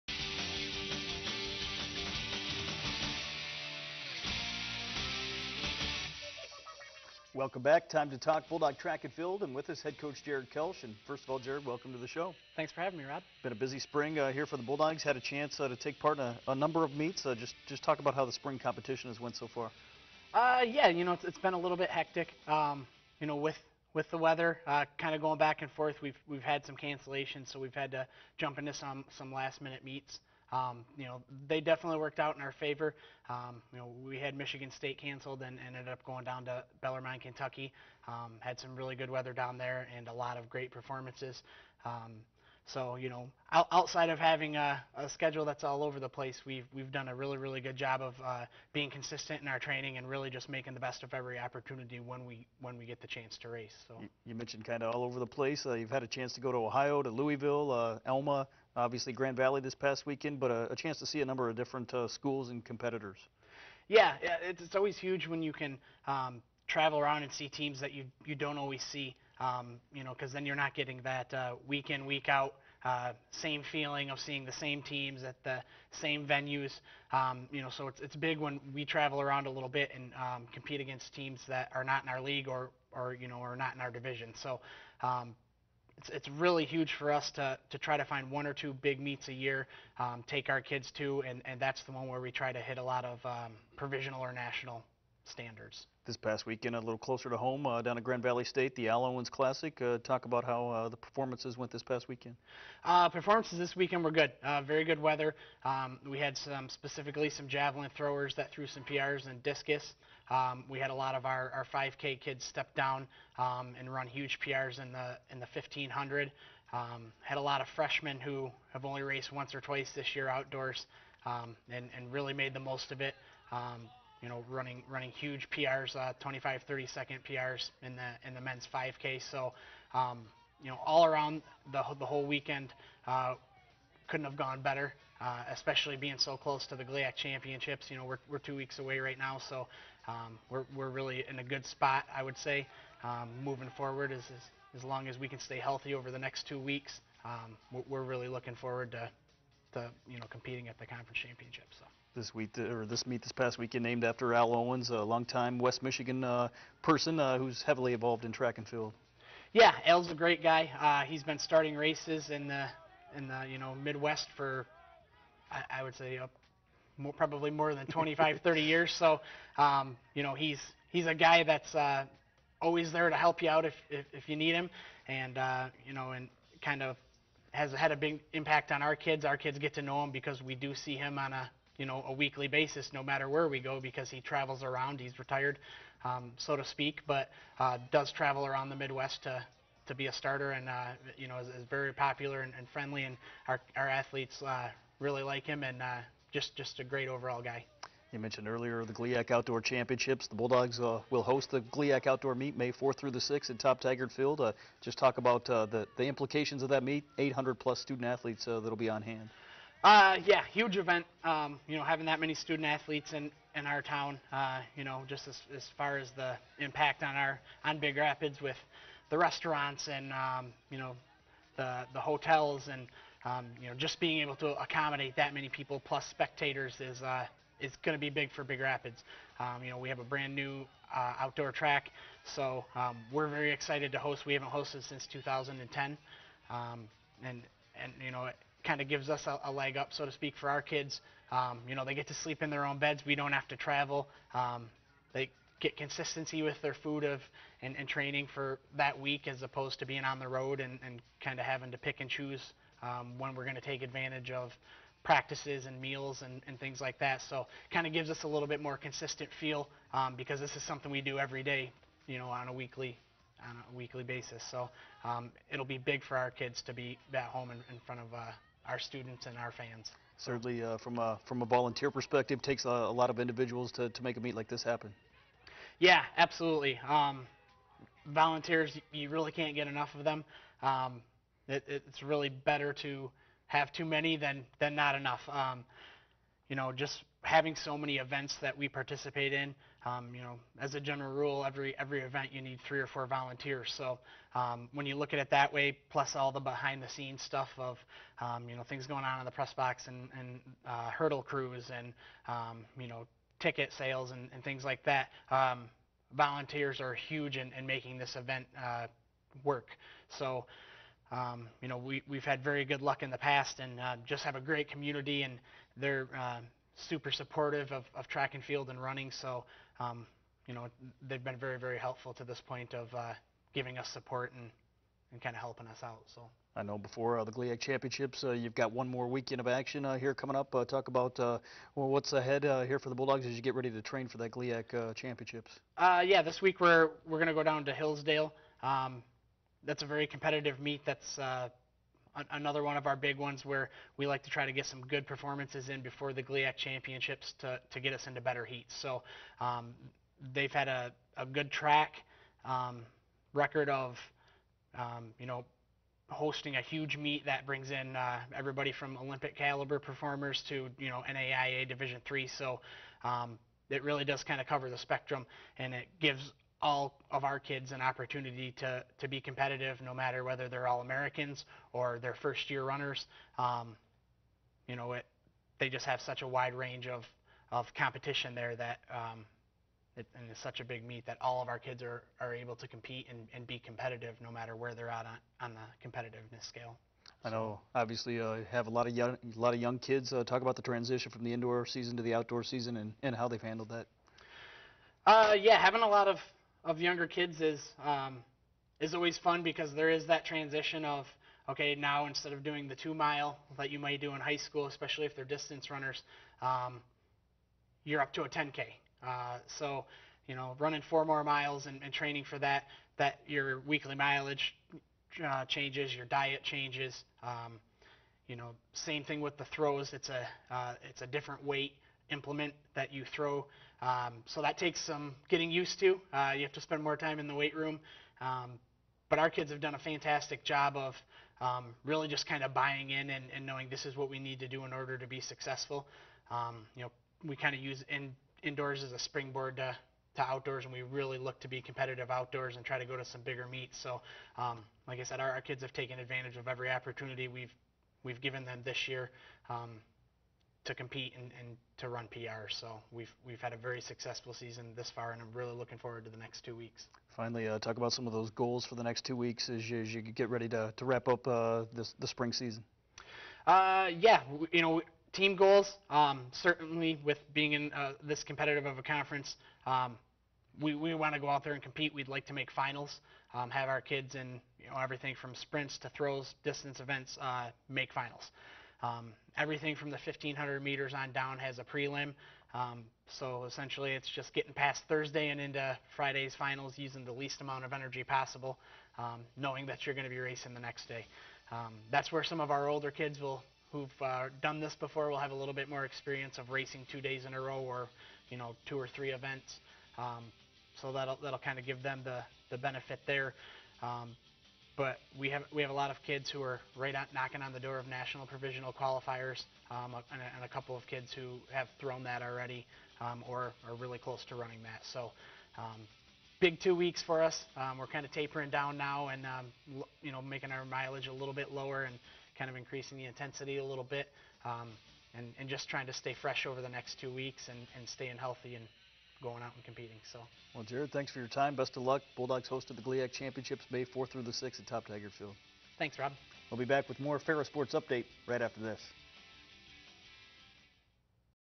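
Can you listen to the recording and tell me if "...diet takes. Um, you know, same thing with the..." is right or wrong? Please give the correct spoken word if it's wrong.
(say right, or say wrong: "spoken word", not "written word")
wrong: "changes", not "takes".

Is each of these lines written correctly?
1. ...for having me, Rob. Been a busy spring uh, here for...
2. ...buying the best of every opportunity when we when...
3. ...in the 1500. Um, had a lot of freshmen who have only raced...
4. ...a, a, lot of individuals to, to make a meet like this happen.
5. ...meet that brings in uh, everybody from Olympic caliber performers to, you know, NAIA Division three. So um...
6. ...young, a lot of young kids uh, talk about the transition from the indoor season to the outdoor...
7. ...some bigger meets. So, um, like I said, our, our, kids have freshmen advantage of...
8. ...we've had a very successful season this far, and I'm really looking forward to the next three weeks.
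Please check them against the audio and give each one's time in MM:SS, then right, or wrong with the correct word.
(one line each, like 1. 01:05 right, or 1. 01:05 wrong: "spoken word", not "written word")
1. 00:12 right
2. 00:50 wrong: "making", not "buying"
3. 01:55 right
4. 04:32 right
5. 05:56 right
6. 06:28 right
7. 07:23 wrong: "taken", not "freshmen"
8. 07:33 wrong: "two", not "three".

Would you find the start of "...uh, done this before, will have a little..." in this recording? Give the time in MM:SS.
08:14.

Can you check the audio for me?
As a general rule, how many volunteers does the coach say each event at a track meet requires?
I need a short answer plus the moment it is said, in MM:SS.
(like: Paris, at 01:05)
three or four, at 04:52.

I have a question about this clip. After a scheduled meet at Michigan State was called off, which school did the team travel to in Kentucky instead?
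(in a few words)
Bellarmine.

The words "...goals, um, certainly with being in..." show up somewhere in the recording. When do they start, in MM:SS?
07:45.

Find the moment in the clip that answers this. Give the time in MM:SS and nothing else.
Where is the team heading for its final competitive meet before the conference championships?
05:37.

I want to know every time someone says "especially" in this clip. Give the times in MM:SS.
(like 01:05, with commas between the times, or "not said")
02:15, 06:44.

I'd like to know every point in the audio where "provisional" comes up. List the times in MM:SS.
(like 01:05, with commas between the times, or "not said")
01:33, 08:28.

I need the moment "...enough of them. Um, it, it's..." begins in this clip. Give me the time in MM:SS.
04:39.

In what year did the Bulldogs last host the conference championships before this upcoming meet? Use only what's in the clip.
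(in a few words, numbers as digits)
2010.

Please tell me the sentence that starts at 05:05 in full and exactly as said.
Um, volunteers are huge in, in making this event uh, work.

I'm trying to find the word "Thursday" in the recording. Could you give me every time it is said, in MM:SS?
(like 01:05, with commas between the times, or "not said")
08:04.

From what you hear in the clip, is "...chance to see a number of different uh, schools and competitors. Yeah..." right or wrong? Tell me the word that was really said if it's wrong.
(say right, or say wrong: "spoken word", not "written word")
right.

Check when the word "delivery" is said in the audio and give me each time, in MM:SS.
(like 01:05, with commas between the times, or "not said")
not said.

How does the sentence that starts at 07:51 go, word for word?
We'd like to make finals, um, have our kids in you know, everything from sprints to throws, distance events, uh, make finals.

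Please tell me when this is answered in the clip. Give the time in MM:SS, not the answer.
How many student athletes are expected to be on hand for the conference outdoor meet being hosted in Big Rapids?
03:27.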